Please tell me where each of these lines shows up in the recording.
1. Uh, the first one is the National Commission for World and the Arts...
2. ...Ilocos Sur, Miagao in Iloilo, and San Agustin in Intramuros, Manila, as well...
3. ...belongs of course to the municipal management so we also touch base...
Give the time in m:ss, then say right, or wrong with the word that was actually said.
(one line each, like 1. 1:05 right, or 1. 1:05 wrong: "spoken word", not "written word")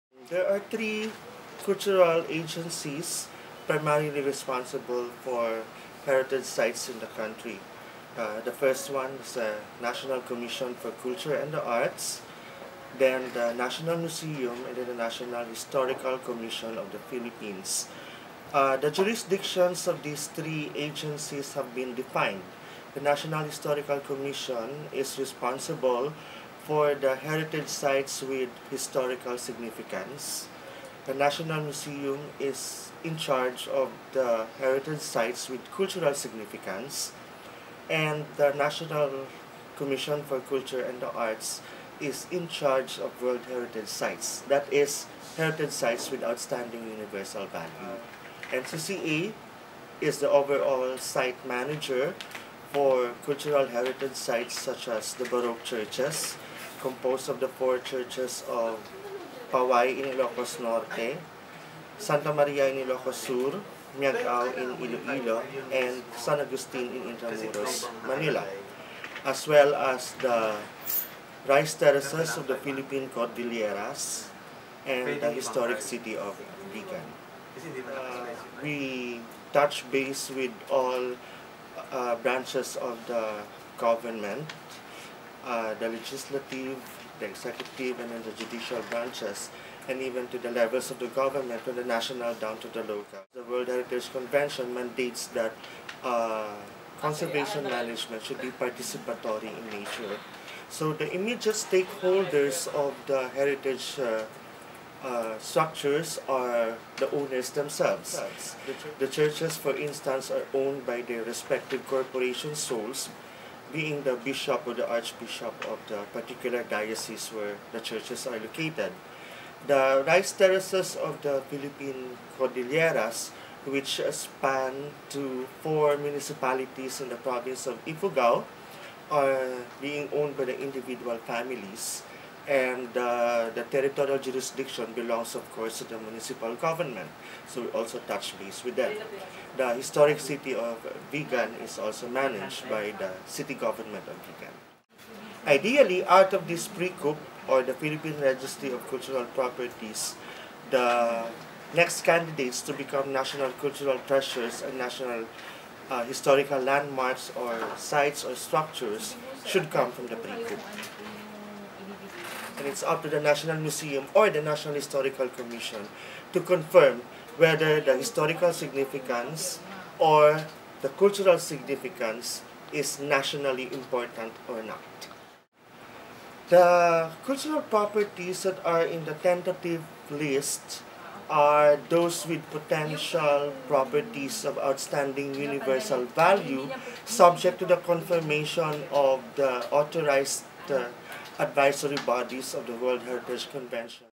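1. 0:08 wrong: "Culture", not "World"
2. 1:02 right
3. 2:14 wrong: "government", not "management".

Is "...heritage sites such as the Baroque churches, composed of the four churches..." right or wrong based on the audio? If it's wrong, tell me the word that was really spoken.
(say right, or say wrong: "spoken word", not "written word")
right.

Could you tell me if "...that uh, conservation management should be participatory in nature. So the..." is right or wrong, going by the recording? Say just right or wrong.
right.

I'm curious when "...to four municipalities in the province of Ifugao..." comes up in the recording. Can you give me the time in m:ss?
2:05.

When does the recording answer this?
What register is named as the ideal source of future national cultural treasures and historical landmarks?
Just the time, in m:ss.
2:27.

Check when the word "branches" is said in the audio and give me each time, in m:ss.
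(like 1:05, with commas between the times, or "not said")
1:22, 1:28.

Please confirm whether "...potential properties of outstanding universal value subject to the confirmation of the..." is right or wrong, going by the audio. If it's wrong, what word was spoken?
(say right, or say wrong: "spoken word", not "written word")
right.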